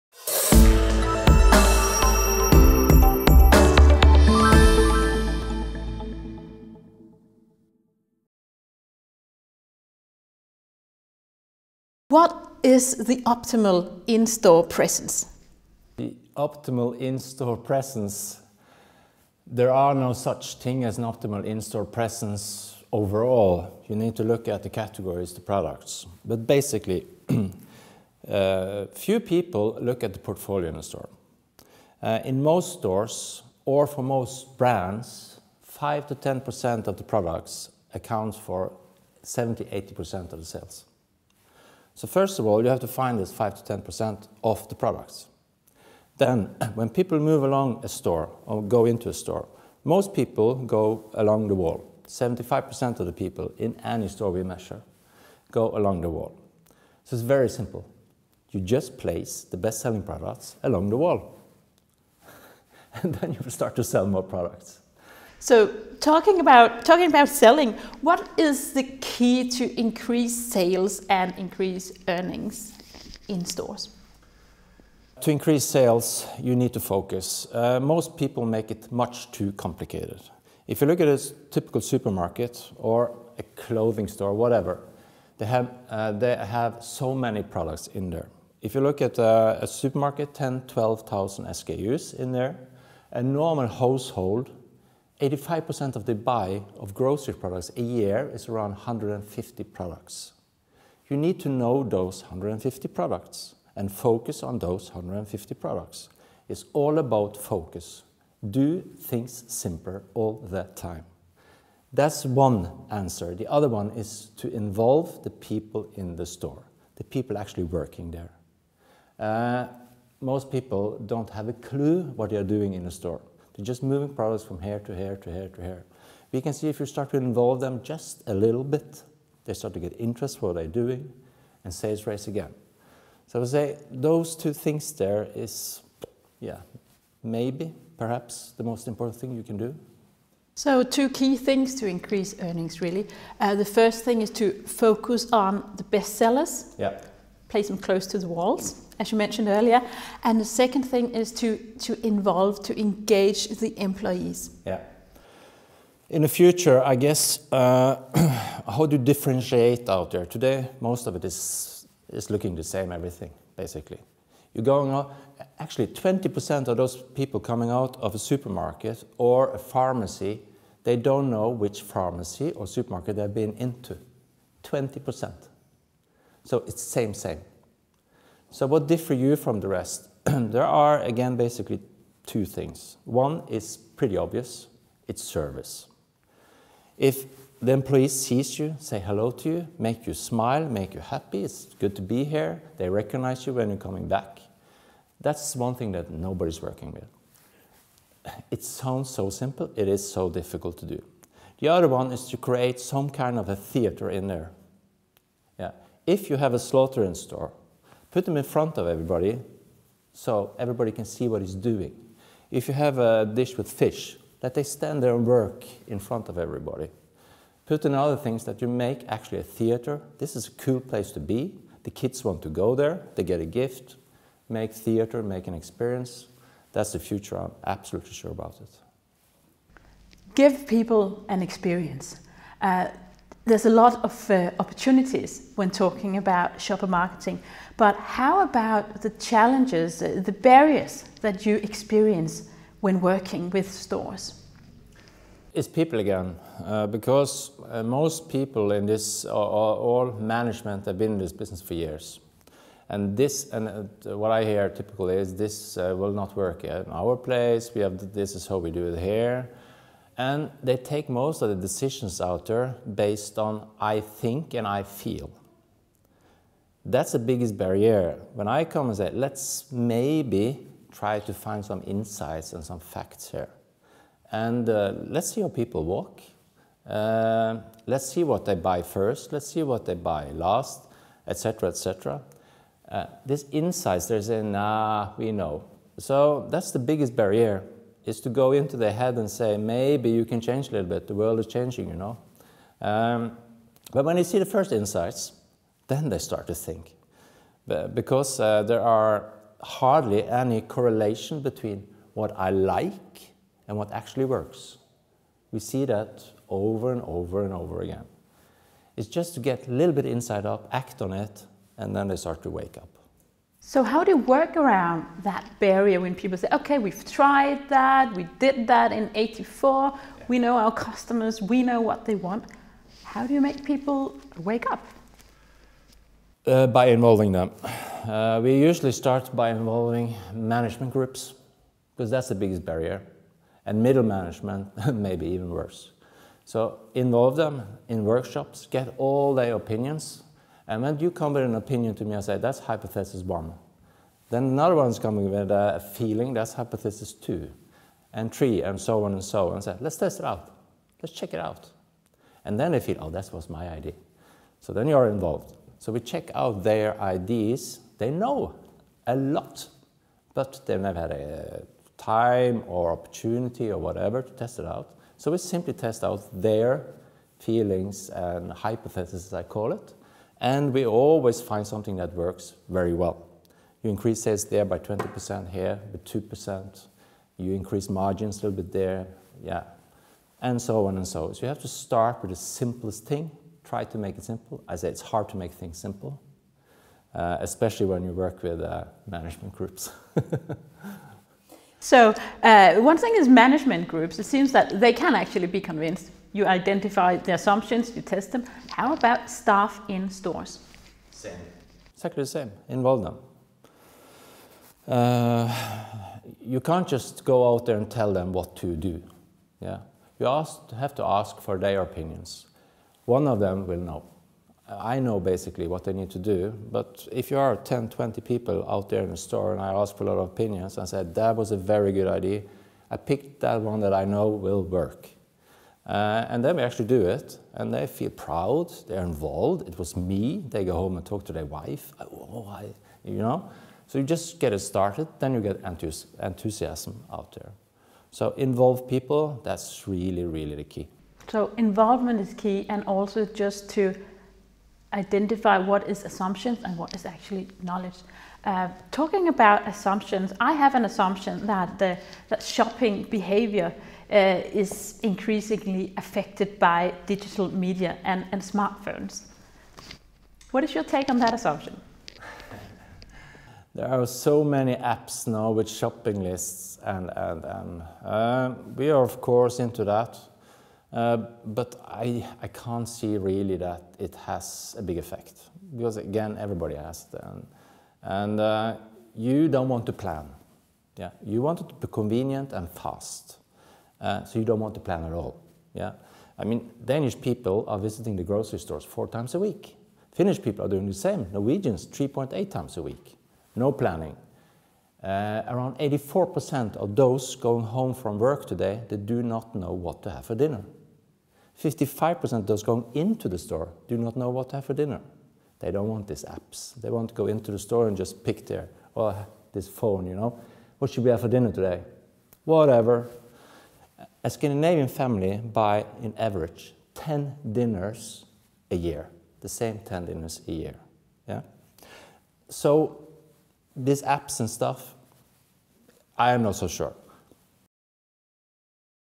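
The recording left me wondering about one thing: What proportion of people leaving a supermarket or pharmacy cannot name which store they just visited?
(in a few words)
20%.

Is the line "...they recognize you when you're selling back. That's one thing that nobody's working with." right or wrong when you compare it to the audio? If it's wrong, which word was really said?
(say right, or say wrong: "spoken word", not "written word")
wrong: "coming", not "selling".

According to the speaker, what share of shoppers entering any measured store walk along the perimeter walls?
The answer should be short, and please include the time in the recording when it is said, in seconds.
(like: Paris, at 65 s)
75%, at 52 s.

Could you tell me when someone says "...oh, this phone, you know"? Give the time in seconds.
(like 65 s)
509 s.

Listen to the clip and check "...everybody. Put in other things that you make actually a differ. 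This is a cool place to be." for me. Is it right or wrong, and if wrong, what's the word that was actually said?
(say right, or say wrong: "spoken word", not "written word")
wrong: "theater", not "differ".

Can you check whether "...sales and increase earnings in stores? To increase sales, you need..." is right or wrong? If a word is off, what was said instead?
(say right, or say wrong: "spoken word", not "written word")
right.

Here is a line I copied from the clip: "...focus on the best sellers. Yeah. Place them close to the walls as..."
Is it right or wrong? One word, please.
right.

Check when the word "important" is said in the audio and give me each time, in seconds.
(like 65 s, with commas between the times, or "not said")
138 s.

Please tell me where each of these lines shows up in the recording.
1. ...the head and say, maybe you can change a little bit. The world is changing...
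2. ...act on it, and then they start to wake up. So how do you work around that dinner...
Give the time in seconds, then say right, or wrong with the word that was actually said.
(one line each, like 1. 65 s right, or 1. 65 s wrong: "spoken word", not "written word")
1. 288 s right
2. 310 s wrong: "barrier", not "dinner".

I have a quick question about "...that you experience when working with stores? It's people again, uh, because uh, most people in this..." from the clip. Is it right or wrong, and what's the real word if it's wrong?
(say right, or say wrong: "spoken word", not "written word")
right.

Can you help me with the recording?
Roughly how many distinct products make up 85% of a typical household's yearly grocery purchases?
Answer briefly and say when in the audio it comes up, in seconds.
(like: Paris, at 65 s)
150, at 98 s.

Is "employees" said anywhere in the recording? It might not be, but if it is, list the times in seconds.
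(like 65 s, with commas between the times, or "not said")
153 s, 187 s.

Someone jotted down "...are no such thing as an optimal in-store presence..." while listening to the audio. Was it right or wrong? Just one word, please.
right.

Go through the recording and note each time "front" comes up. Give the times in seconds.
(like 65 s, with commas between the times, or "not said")
208 s, 215 s.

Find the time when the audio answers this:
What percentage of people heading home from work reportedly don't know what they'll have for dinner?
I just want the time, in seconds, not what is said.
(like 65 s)
495 s.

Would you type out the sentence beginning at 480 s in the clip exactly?
Yeah, you want it to be convenient and fast.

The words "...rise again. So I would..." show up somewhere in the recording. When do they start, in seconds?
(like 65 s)
132 s.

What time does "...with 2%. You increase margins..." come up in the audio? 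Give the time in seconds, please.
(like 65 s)
375 s.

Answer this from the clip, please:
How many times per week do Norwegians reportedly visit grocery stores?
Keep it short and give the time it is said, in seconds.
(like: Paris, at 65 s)
3.8, at 491 s.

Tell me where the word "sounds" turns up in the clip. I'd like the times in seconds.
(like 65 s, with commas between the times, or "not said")
198 s.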